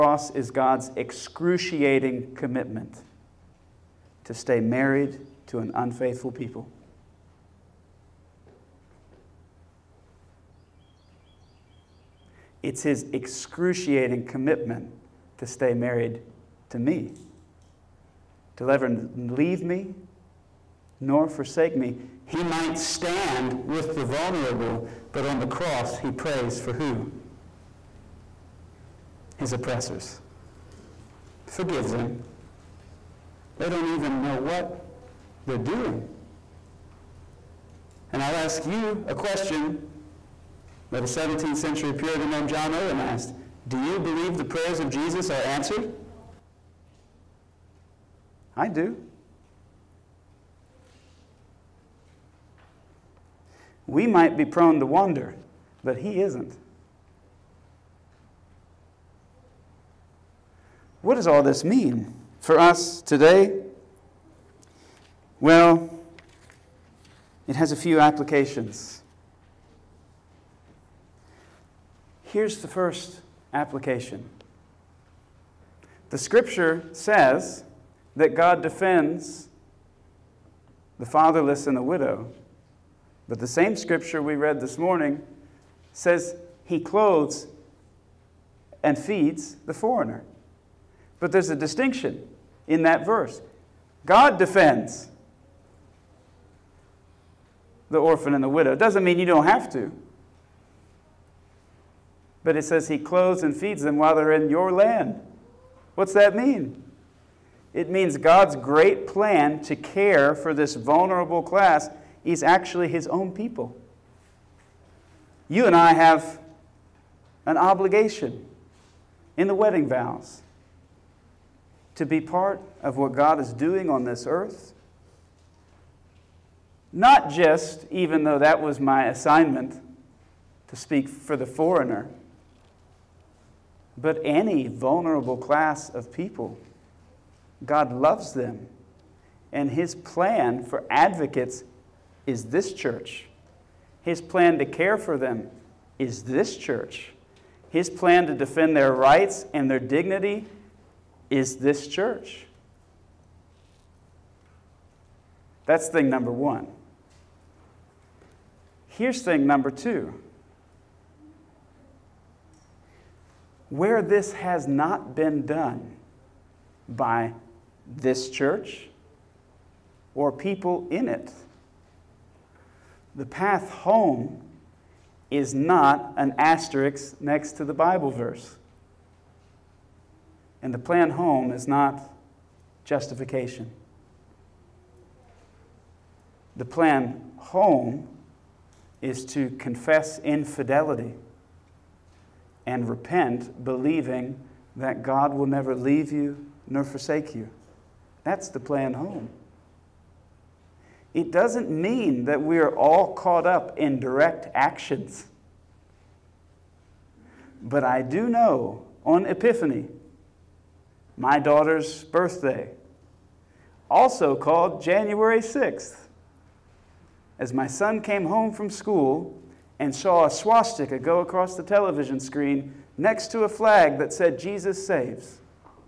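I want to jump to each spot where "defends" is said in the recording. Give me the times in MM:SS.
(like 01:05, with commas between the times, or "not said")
01:18, 01:34, 02:28.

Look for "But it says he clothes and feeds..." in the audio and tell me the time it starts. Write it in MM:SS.
01:42.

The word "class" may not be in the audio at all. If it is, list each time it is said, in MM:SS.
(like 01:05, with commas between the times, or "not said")
01:51, 02:15.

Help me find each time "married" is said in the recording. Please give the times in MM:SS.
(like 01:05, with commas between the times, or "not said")
00:04, 00:15.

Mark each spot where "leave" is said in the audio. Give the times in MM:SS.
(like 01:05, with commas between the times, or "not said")
00:19, 03:15.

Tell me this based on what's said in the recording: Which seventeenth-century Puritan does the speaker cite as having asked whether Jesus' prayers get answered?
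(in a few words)
John Owen.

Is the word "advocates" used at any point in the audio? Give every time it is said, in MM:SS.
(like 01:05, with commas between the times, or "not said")
02:20.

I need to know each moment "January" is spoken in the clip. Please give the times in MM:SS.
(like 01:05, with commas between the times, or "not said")
03:34.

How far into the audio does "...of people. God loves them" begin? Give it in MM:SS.
02:15.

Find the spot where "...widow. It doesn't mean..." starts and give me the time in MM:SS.
01:38.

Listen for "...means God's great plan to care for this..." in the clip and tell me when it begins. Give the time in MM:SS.
01:47.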